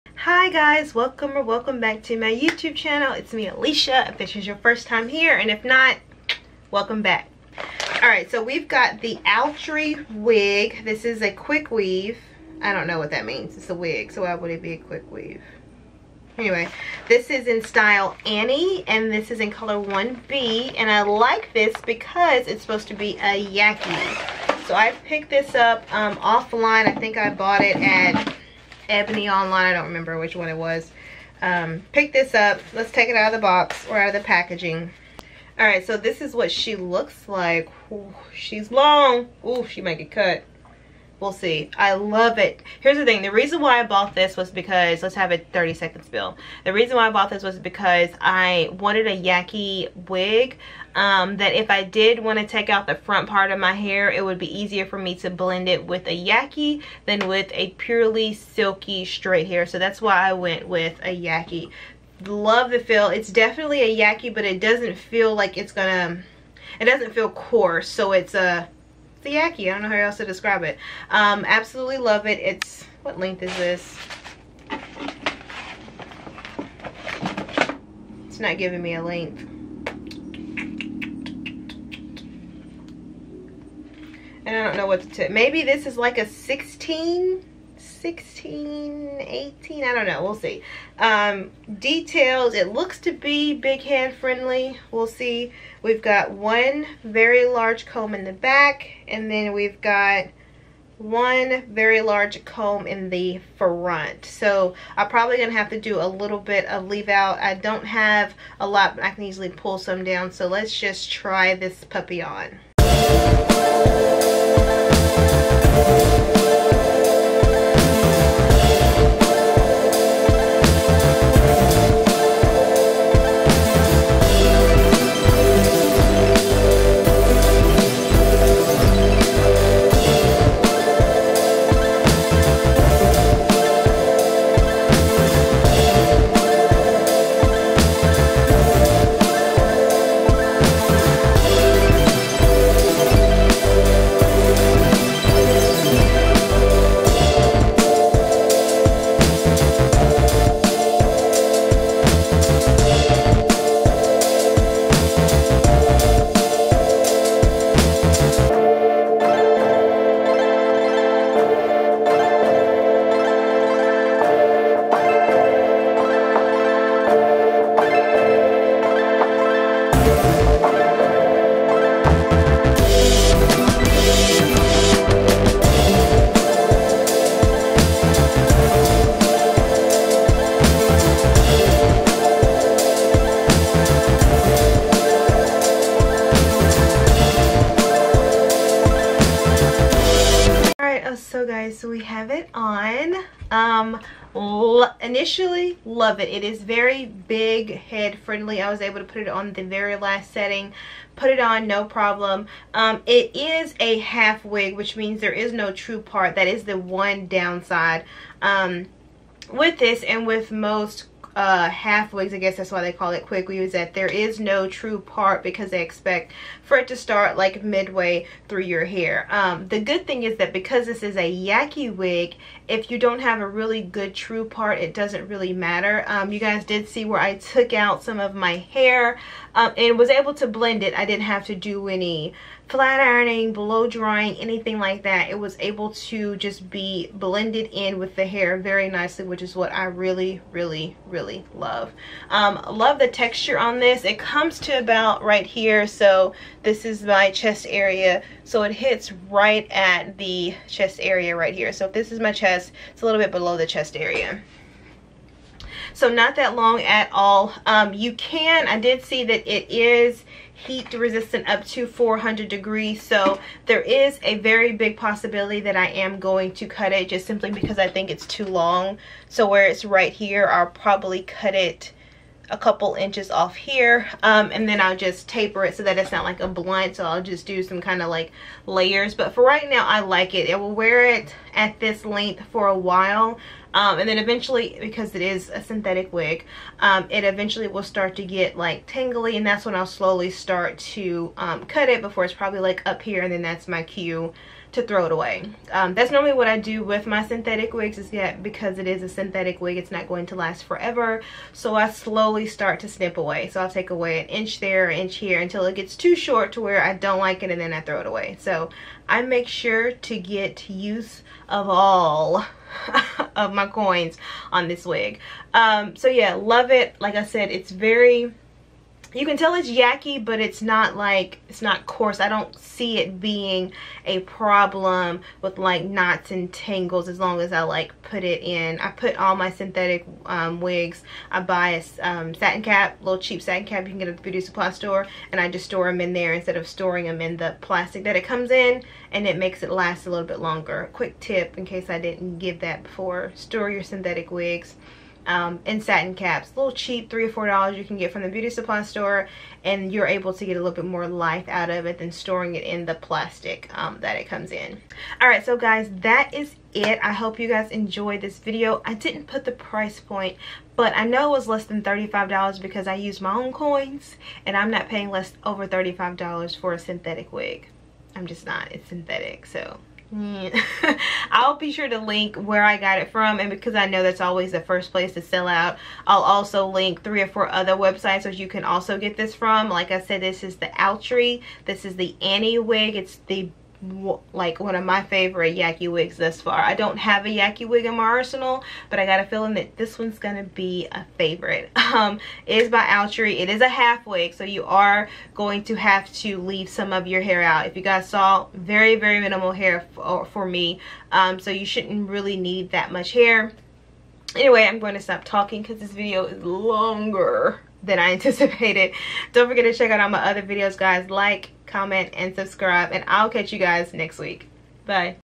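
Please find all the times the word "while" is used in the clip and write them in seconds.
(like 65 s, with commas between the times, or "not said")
282 s.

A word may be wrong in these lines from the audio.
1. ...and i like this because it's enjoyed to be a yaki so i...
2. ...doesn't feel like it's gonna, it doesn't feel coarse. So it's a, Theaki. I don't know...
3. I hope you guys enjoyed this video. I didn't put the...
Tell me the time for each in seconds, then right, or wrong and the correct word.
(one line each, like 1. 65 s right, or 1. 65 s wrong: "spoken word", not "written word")
1. 20 s wrong: "supposed", not "enjoyed"
2. 64 s right
3. 357 s right.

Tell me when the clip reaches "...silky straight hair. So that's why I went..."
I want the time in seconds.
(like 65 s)
58 s.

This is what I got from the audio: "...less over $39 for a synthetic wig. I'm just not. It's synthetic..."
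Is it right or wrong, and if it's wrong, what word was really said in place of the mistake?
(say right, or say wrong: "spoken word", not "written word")
wrong: "35", not "39".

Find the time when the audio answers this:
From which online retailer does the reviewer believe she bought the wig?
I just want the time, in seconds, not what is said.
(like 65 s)
28 s.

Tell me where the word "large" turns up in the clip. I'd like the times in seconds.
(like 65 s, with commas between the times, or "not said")
97 s, 102 s.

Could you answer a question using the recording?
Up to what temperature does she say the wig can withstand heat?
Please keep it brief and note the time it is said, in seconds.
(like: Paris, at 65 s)
400 degrees, at 261 s.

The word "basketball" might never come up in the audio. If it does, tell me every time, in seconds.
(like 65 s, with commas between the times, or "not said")
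not said.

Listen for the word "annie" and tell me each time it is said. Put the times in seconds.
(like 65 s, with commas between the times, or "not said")
18 s, 382 s.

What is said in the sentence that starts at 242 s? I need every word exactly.
Um, love the texture on this.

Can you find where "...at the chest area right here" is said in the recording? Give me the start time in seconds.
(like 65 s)
249 s.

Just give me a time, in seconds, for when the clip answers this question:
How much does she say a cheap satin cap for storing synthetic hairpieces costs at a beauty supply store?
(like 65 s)
347 s.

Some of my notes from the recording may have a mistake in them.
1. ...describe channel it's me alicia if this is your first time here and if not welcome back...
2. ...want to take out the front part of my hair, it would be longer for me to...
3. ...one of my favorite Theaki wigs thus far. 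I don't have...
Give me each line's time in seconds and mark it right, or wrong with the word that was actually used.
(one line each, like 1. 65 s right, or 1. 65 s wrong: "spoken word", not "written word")
1. 2 s wrong: "youtube", not "describe"
2. 52 s wrong: "easier", not "longer"
3. 384 s wrong: "Yaki", not "Theaki".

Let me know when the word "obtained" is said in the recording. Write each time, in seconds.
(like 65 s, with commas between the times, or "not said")
not said.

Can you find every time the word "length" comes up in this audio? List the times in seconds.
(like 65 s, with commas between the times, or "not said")
73 s, 79 s, 282 s.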